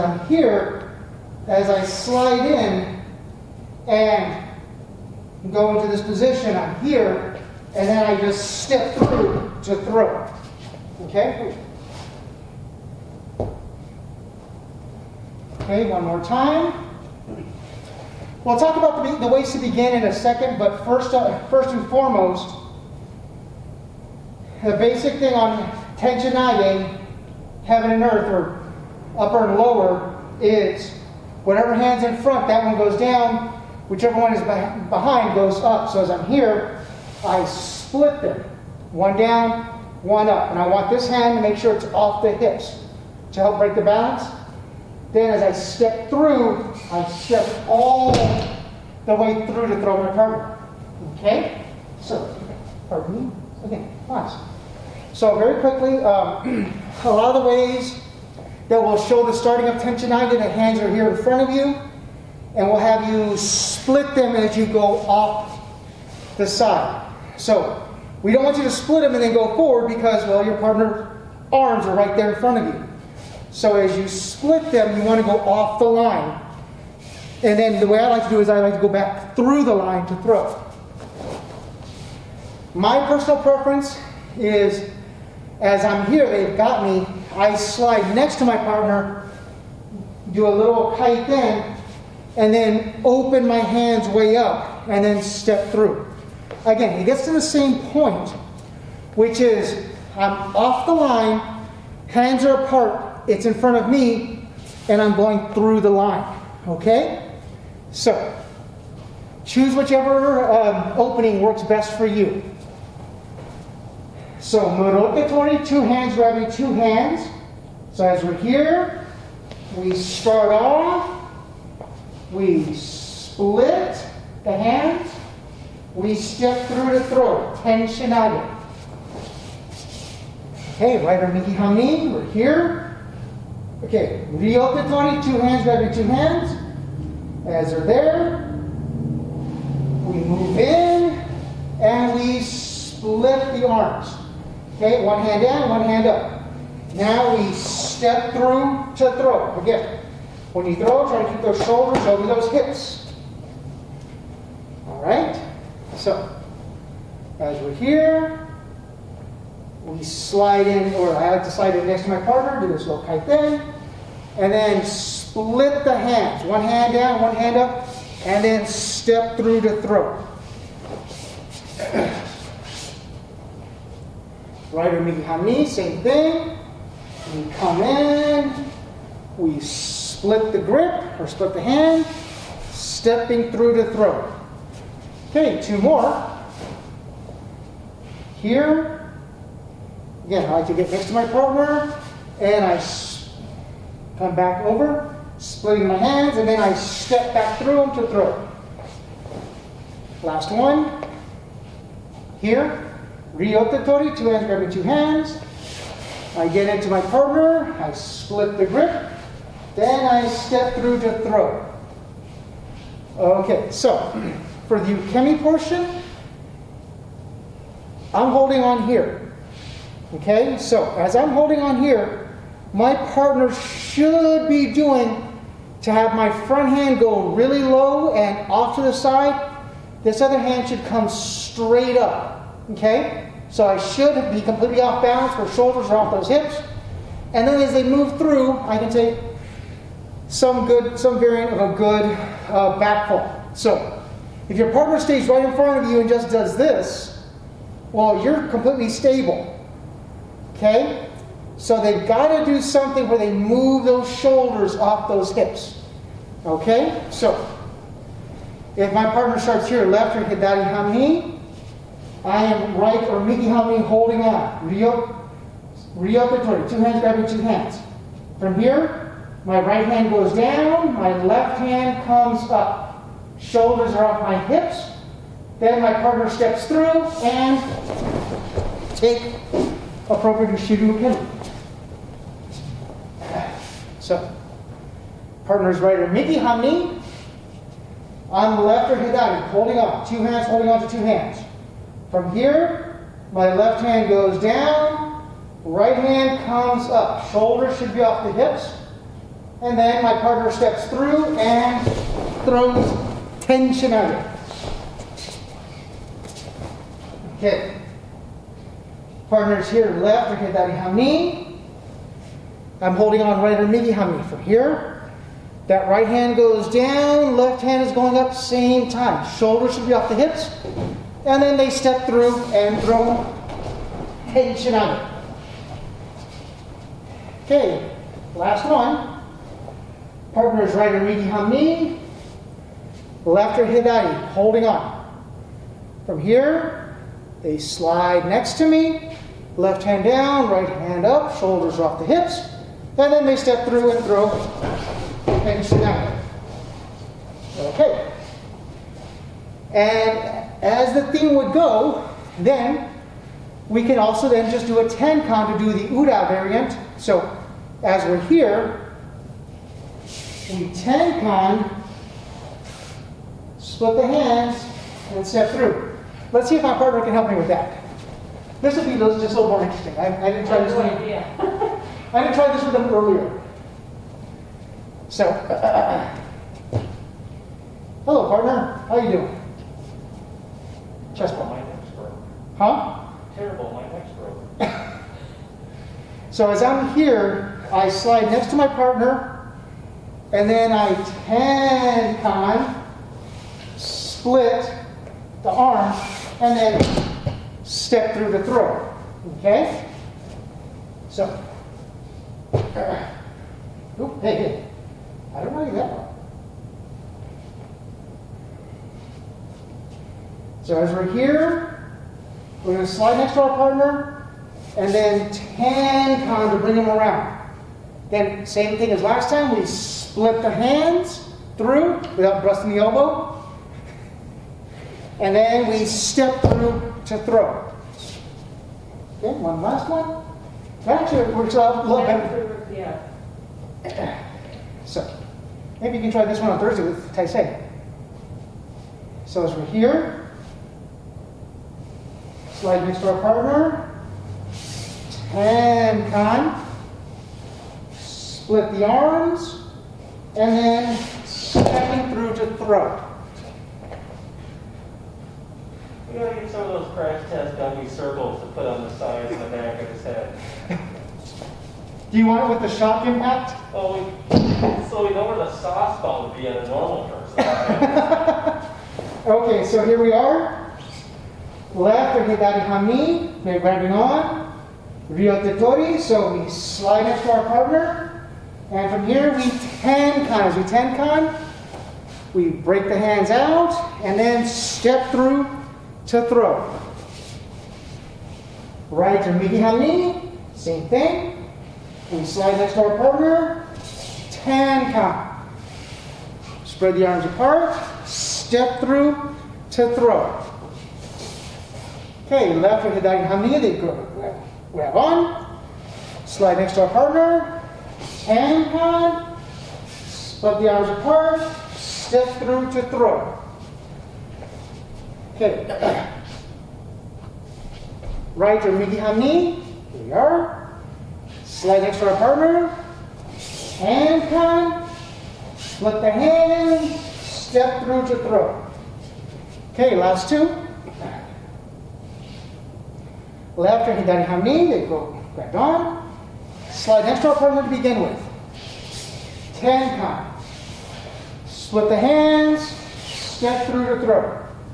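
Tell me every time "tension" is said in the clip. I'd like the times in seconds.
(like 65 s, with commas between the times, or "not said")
303 s, 324 s, 345 s.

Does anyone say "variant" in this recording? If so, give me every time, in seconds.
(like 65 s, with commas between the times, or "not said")
241 s, 356 s.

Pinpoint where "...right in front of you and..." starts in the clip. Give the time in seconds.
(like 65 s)
245 s.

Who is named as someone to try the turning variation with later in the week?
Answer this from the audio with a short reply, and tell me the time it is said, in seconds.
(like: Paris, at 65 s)
Taisei, at 437 s.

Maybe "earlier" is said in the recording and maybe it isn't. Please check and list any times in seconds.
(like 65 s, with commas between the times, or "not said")
372 s.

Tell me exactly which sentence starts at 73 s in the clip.
So as you split them, you want to go off the line.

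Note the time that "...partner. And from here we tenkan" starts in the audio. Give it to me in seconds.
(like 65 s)
477 s.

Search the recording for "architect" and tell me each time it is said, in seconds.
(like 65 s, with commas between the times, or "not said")
not said.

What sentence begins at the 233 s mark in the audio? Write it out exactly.
So I should be completely off balance where shoulders are off those hips.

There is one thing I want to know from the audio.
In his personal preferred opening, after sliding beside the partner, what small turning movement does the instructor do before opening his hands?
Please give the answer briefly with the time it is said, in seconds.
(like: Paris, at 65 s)
A little kaiten, at 90 s.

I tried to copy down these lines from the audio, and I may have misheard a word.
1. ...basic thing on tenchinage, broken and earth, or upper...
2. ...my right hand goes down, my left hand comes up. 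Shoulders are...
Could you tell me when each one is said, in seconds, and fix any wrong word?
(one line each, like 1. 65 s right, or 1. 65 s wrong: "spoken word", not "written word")
1. 24 s wrong: "heaven", not "broken"
2. 269 s right.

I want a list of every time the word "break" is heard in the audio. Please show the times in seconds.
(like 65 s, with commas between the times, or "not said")
43 s, 482 s.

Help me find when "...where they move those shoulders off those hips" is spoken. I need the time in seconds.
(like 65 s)
253 s.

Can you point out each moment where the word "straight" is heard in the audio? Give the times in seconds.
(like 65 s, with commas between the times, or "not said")
231 s.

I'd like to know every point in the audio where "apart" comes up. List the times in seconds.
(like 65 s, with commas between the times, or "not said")
102 s, 497 s, 510 s.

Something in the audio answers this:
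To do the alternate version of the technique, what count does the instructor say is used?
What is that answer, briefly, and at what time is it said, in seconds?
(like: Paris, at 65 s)
A 10 count, at 354 s.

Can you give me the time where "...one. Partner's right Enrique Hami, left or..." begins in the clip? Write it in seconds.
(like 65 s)
328 s.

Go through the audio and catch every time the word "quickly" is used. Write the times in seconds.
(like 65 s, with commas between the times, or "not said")
55 s.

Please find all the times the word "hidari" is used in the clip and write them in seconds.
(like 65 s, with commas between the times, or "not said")
260 s, 288 s, 333 s, 502 s, 533 s.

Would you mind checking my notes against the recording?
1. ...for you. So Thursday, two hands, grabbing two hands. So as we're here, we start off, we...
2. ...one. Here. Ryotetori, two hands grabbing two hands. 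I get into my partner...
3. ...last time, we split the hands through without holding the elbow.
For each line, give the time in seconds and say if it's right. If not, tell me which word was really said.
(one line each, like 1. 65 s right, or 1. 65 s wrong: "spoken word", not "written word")
1. 111 s wrong: "Murotkatori", not "Thursday"
2. 200 s right
3. 419 s wrong: "busting", not "holding".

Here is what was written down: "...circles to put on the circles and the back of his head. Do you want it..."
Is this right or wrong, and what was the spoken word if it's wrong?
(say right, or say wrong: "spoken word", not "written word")
wrong: "sides", not "circles".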